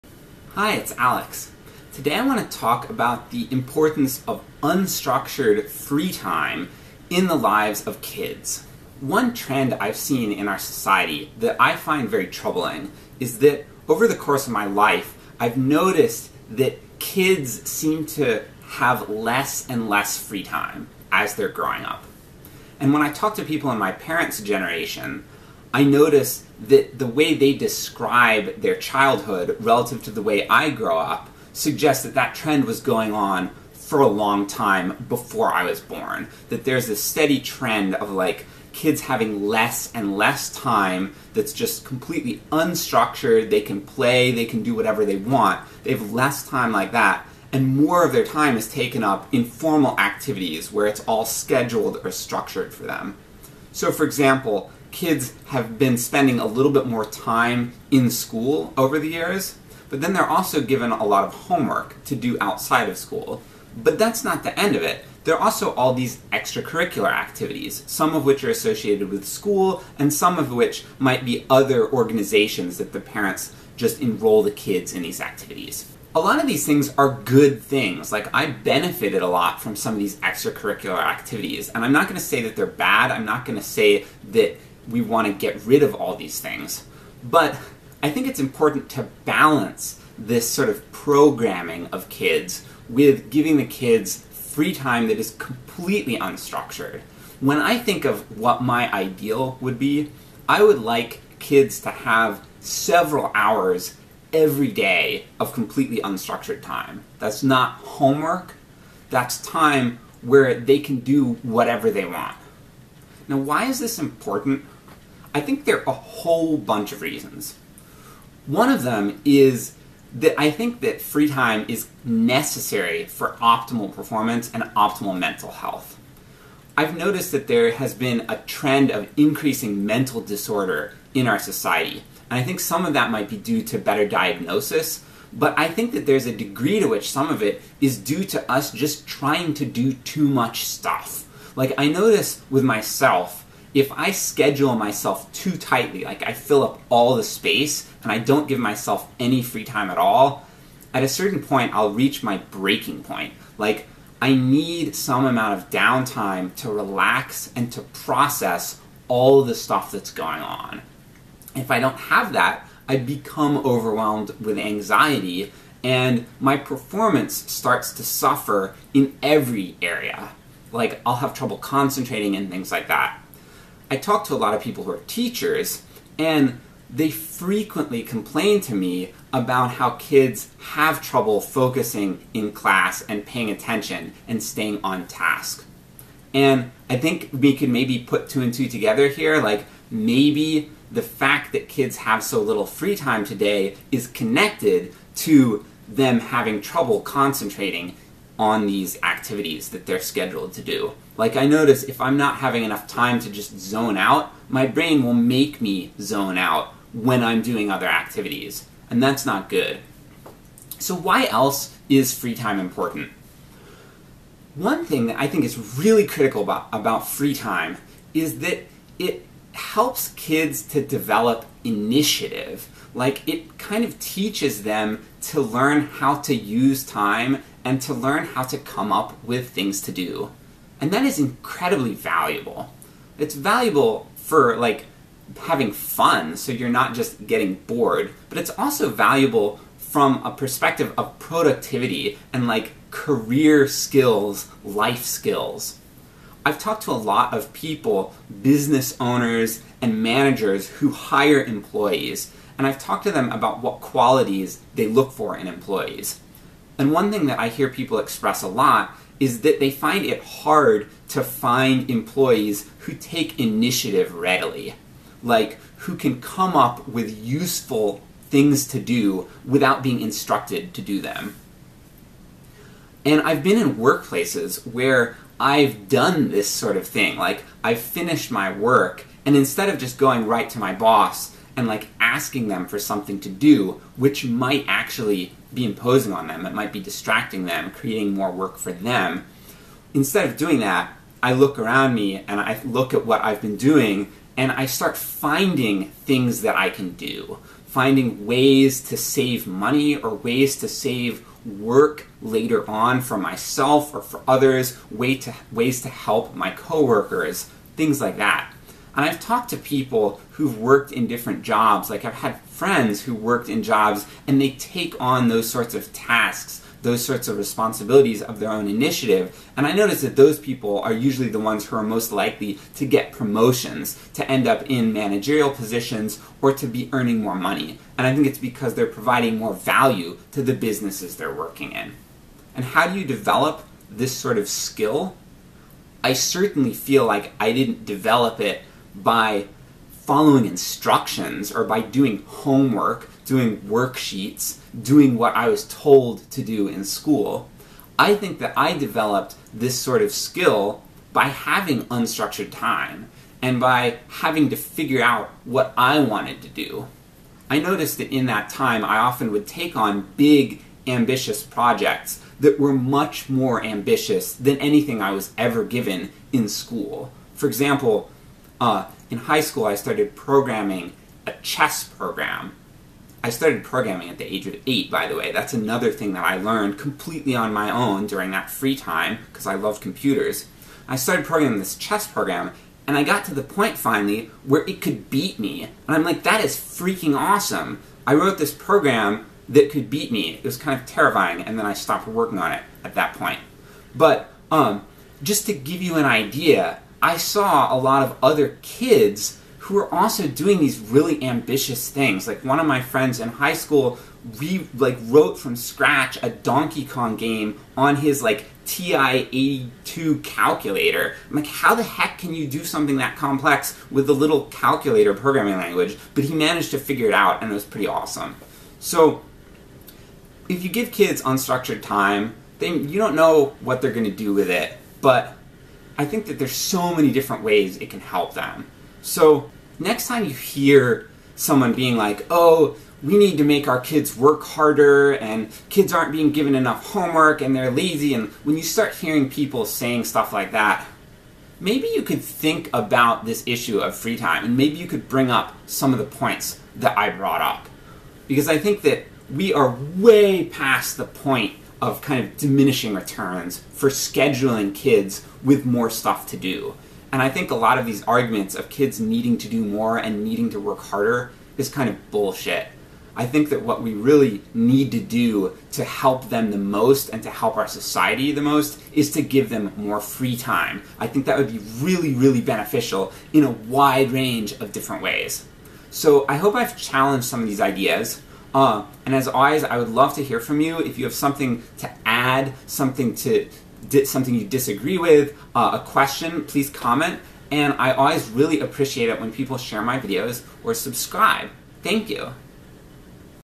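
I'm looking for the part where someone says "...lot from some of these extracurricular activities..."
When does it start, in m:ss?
1:19.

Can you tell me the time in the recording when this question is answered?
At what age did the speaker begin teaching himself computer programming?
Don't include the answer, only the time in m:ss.
6:14.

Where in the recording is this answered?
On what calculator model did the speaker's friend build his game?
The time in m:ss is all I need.
6:48.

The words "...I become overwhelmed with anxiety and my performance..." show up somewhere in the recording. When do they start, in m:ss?
2:42.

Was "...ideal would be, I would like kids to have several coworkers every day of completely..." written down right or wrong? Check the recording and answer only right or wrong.
wrong.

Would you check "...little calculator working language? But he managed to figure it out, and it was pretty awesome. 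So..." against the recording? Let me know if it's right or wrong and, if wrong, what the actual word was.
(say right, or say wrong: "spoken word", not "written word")
wrong: "programming", not "working".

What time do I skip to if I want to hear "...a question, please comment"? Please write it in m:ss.
8:05.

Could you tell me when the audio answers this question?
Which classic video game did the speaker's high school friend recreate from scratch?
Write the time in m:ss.
6:46.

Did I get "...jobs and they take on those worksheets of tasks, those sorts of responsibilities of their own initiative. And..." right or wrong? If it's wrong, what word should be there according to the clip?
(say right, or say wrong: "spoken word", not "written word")
wrong: "sorts", not "worksheets".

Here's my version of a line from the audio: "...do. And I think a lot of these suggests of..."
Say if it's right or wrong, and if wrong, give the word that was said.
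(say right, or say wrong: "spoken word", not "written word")
wrong: "arguments", not "suggests".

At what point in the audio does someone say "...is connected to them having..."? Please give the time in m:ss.
3:13.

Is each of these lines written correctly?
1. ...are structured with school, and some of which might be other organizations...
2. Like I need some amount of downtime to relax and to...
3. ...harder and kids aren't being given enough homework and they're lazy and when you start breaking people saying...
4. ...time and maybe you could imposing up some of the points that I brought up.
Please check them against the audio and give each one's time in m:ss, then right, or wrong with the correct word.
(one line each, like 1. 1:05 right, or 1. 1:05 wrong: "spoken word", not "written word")
1. 1:08 wrong: "associated", not "structured"
2. 2:33 right
3. 7:14 wrong: "hearing", not "breaking"
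4. 7:24 wrong: "bring", not "imposing".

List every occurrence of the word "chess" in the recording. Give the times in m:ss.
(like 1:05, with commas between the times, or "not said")
6:11, 6:21.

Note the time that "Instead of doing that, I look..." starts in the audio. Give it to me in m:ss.
4:49.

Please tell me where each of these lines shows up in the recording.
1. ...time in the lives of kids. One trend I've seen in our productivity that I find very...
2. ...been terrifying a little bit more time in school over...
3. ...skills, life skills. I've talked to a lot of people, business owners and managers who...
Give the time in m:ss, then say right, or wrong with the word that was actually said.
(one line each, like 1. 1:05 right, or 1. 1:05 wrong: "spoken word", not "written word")
1. 0:06 wrong: "society", not "productivity"
2. 0:55 wrong: "spending", not "terrifying"
3. 4:03 right.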